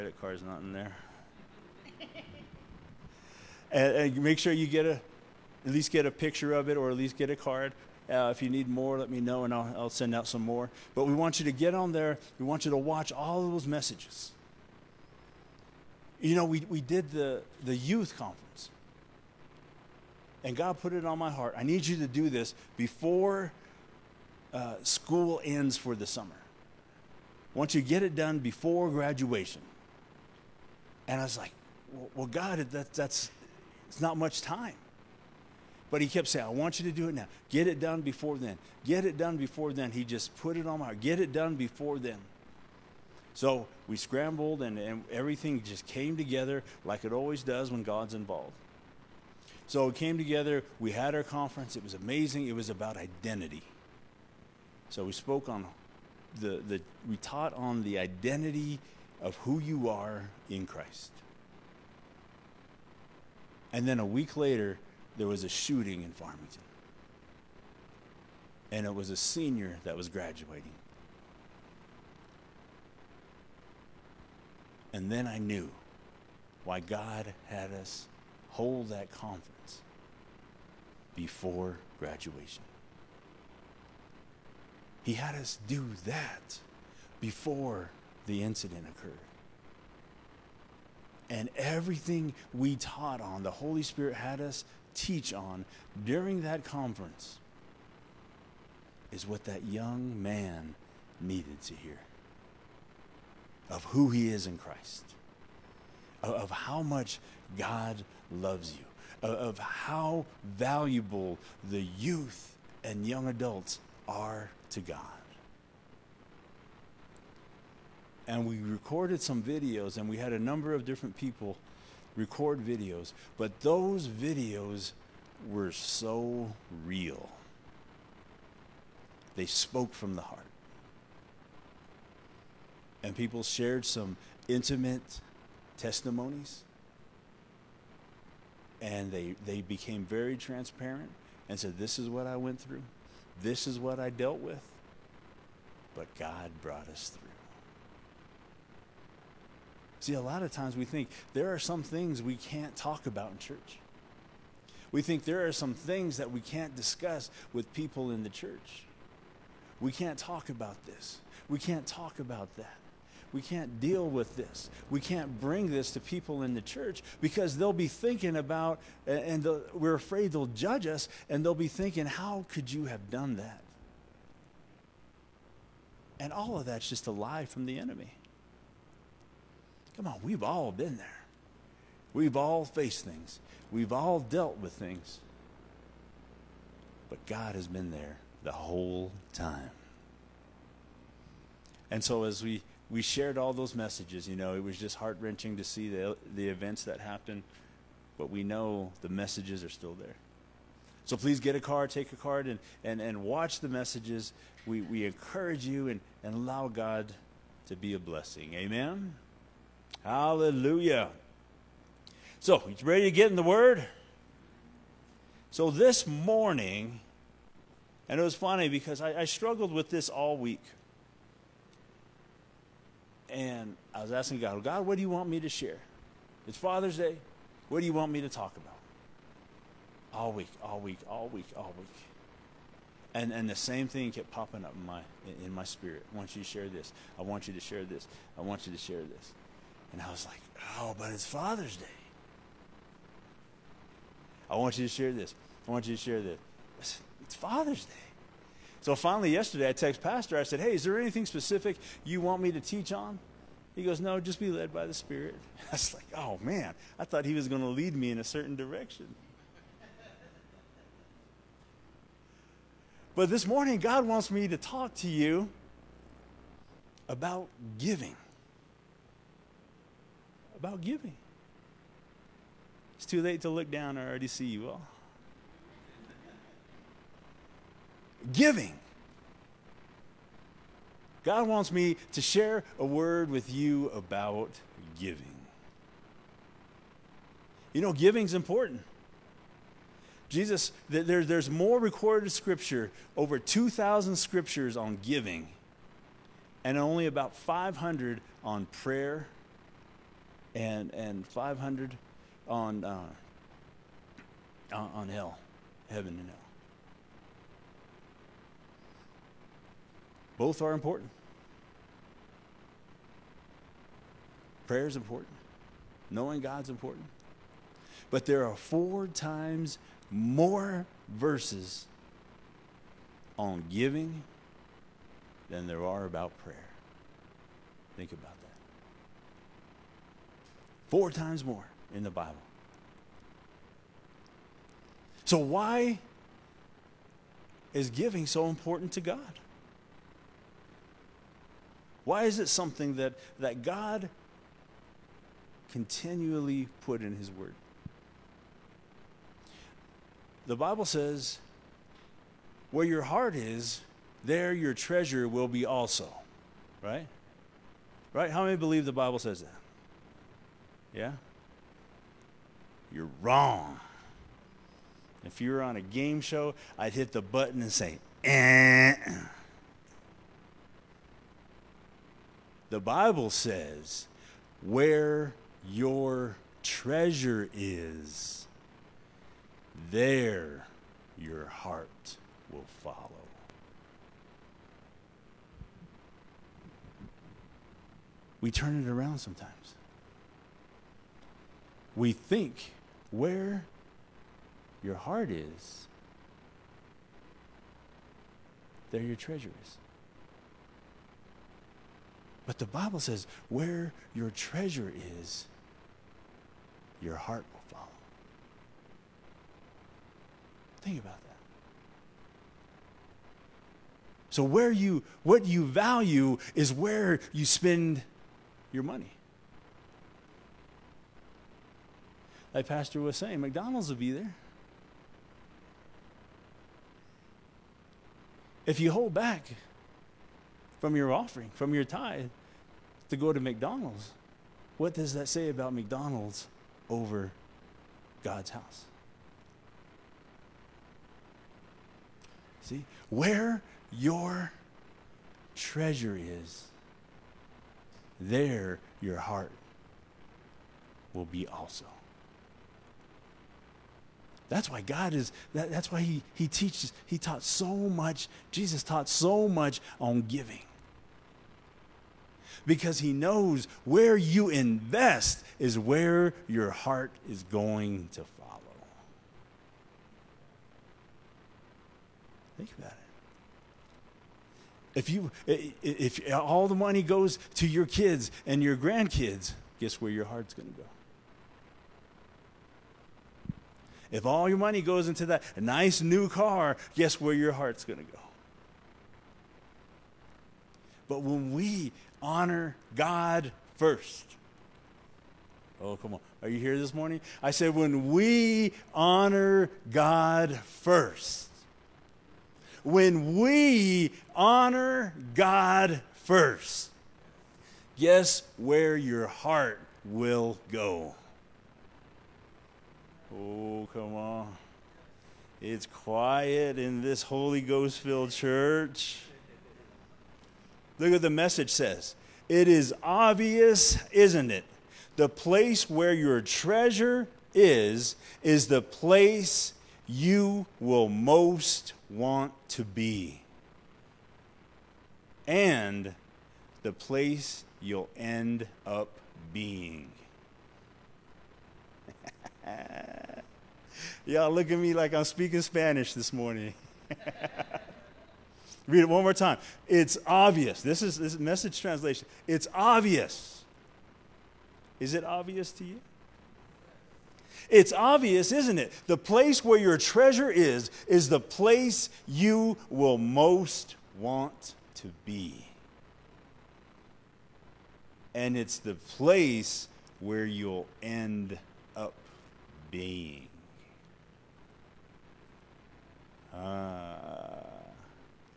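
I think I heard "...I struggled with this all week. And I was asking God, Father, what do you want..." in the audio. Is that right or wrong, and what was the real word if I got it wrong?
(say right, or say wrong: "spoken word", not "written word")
wrong: "God", not "Father".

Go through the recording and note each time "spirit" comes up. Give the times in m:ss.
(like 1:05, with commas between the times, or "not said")
1:33, 3:55, 4:14.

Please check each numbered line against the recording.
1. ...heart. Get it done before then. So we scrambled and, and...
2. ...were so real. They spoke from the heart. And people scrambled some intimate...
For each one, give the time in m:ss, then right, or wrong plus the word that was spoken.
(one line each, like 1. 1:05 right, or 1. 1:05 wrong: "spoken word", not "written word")
1. 0:40 right
2. 2:05 wrong: "shared", not "scrambled".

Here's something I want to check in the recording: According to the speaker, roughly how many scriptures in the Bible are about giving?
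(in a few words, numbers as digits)
Over 2,000.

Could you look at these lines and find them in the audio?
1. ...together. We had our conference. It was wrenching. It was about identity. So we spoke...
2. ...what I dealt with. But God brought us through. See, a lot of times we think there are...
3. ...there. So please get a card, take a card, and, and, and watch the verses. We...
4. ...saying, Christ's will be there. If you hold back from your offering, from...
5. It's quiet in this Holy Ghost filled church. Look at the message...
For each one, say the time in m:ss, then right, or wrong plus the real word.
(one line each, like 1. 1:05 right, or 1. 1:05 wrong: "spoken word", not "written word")
1. 0:50 wrong: "amazing", not "wrenching"
2. 2:23 right
3. 3:19 wrong: "messages", not "verses"
4. 7:03 wrong: "McDonald", not "Christ"
5. 8:35 right.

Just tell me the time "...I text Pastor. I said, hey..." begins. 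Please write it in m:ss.
4:09.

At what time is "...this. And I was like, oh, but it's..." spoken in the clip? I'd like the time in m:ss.
3:59.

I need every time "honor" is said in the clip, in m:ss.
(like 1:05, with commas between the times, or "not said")
8:12, 8:18, 8:24.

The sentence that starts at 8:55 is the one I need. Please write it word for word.
And the place you'll end up being.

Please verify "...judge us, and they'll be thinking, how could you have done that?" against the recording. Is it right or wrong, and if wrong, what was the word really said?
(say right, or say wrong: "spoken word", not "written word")
right.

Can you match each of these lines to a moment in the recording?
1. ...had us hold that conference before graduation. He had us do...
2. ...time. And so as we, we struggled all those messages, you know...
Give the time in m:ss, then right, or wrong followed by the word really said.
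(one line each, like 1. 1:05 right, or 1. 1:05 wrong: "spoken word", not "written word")
1. 1:17 right
2. 3:09 wrong: "shared", not "struggled".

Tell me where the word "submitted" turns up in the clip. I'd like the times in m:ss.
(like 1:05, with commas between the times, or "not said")
not said.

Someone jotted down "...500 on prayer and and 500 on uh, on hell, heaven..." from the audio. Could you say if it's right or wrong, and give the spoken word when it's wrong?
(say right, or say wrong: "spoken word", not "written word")
right.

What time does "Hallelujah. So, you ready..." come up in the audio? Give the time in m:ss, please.
3:30.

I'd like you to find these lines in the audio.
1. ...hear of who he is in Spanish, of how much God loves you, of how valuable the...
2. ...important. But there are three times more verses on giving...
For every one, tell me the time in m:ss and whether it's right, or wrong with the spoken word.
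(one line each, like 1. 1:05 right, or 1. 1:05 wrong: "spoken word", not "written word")
1. 1:41 wrong: "Christ", not "Spanish"
2. 5:16 wrong: "four", not "three".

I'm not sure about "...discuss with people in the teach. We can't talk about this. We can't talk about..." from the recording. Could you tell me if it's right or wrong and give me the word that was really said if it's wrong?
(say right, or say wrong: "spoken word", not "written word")
wrong: "church", not "teach".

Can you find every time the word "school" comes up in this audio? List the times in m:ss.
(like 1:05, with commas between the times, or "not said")
0:24.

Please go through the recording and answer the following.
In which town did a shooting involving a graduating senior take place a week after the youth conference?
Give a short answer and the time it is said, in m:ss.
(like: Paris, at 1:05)
Farmington, at 1:05.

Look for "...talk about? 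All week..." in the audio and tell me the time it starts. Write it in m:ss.
3:48.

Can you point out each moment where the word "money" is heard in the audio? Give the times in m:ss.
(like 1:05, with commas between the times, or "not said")
6:58, 7:56, 8:04.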